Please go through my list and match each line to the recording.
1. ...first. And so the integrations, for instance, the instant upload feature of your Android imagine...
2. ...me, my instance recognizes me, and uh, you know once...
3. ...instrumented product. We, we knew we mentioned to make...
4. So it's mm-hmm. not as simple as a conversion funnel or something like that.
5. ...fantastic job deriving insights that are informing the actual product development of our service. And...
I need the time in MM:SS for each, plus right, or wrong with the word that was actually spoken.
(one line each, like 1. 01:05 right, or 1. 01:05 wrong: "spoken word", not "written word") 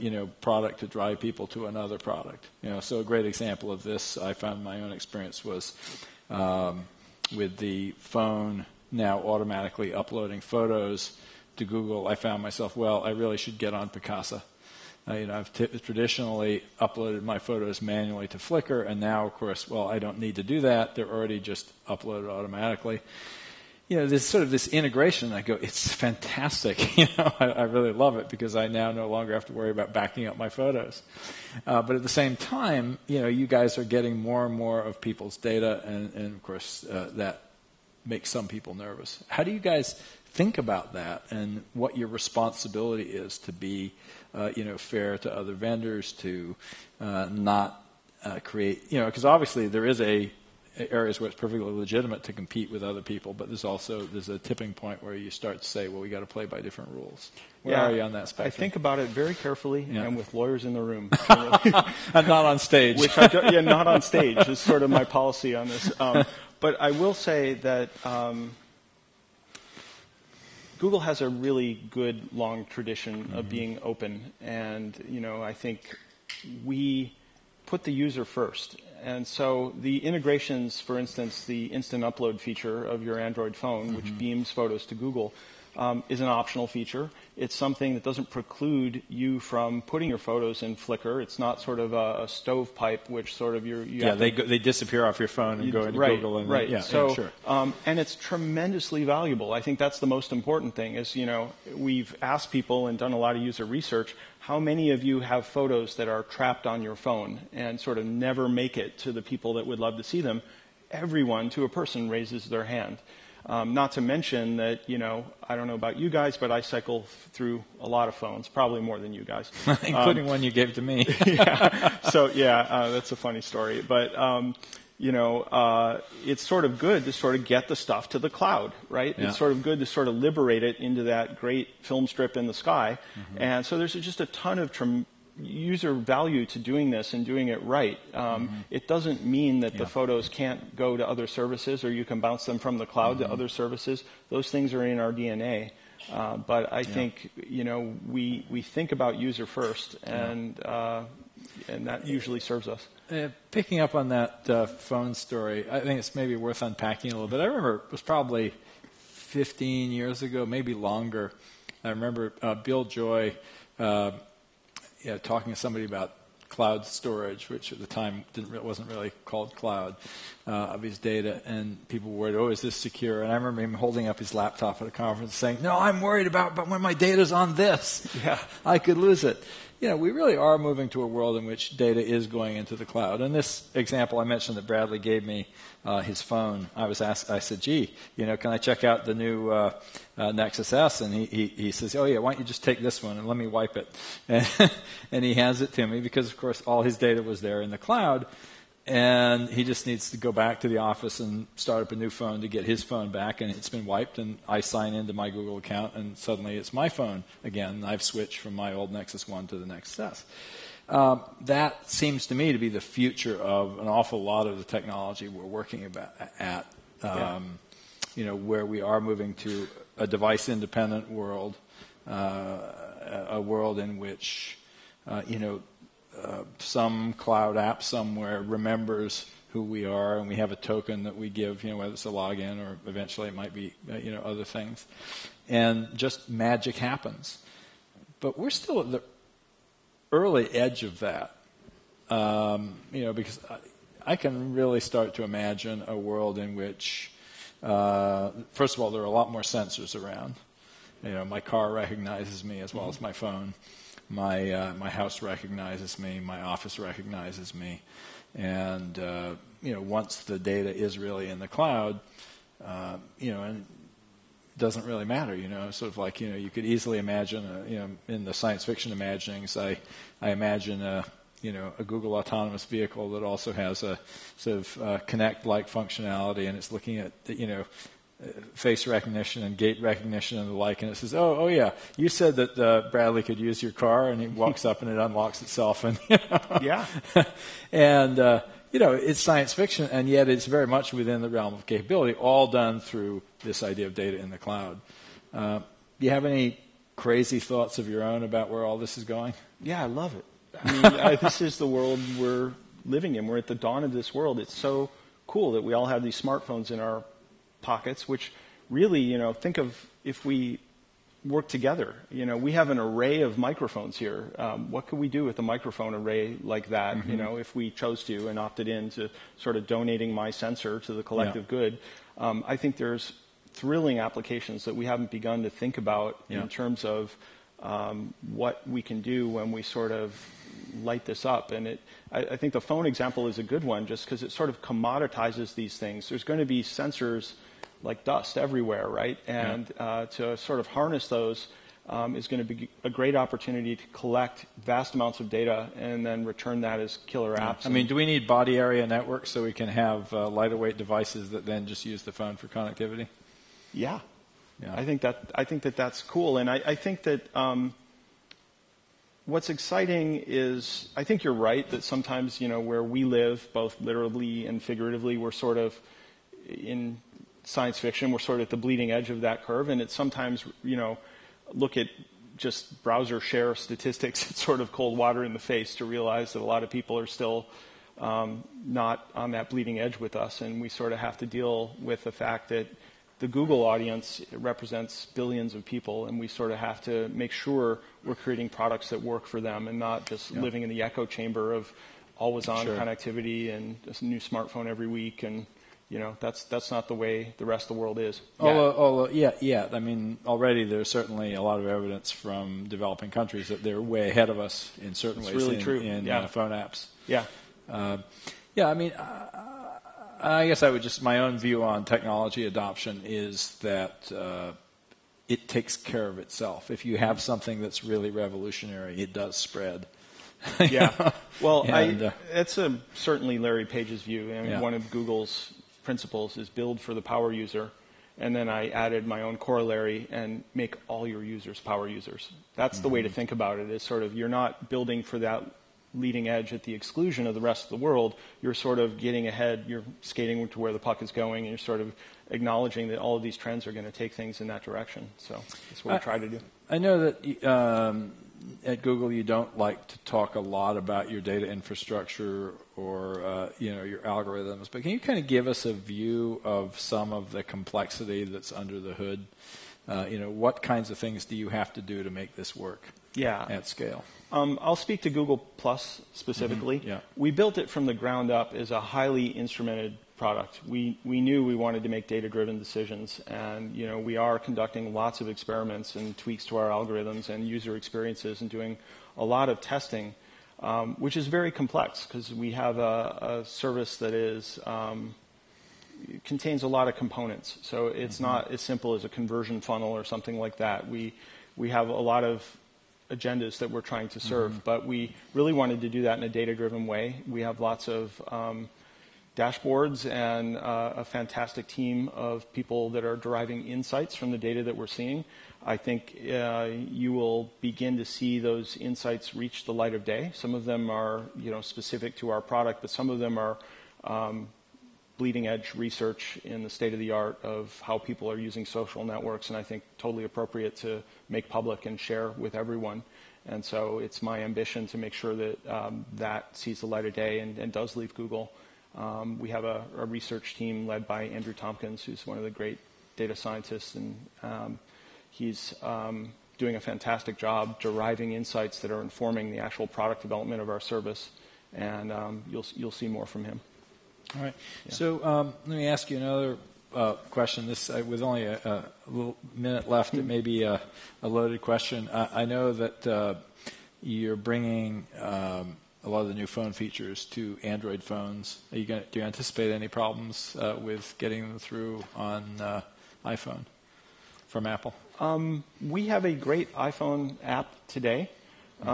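1. 01:18 wrong: "phone", not "imagine"
2. 04:15 wrong: "office", not "instance"
3. 07:49 wrong: "wanted", not "mentioned"
4. 08:07 right
5. 08:56 right.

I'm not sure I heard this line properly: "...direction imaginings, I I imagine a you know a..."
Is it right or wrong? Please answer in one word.
wrong.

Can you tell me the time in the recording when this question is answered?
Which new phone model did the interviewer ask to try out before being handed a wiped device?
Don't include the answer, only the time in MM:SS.
03:10.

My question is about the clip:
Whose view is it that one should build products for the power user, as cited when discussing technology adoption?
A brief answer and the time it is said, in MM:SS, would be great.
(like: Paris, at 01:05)
Larry Page, at 07:03.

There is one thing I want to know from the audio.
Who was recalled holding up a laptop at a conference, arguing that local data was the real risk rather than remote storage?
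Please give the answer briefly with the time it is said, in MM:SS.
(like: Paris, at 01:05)
Bill Joy, at 02:42.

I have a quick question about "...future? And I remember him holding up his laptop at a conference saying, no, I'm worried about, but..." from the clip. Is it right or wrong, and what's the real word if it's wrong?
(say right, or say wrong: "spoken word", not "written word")
wrong: "secure", not "future".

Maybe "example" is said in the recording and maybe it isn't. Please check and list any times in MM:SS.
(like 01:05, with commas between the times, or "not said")
00:03, 03:03, 05:32.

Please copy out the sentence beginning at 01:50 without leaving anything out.
Everyone to a person raises their hand.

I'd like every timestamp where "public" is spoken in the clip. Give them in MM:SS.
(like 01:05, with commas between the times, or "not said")
08:41.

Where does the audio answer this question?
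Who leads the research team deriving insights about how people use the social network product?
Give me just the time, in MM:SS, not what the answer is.
08:51.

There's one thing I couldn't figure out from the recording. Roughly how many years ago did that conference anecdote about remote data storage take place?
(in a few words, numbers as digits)
15.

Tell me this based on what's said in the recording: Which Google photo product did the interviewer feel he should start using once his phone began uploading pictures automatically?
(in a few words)
Picasa.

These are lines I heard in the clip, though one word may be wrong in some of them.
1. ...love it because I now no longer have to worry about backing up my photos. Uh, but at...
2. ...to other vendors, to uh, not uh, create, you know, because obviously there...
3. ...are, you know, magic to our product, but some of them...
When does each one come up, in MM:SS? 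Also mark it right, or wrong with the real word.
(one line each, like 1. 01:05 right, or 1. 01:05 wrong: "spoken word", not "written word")
1. 00:27 right
2. 00:45 right
3. 08:30 wrong: "specific", not "magic".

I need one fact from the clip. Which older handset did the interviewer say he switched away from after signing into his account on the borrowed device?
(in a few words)
Nexus 1.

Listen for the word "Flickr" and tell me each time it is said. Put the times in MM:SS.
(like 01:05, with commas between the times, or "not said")
00:18, 01:30.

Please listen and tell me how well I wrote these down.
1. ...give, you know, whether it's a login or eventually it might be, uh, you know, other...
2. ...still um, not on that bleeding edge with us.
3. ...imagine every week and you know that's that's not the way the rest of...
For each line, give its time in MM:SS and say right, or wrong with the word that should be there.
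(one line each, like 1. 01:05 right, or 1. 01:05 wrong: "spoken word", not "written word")
1. 03:51 right
2. 06:17 right
3. 06:34 wrong: "smartphone", not "imagine".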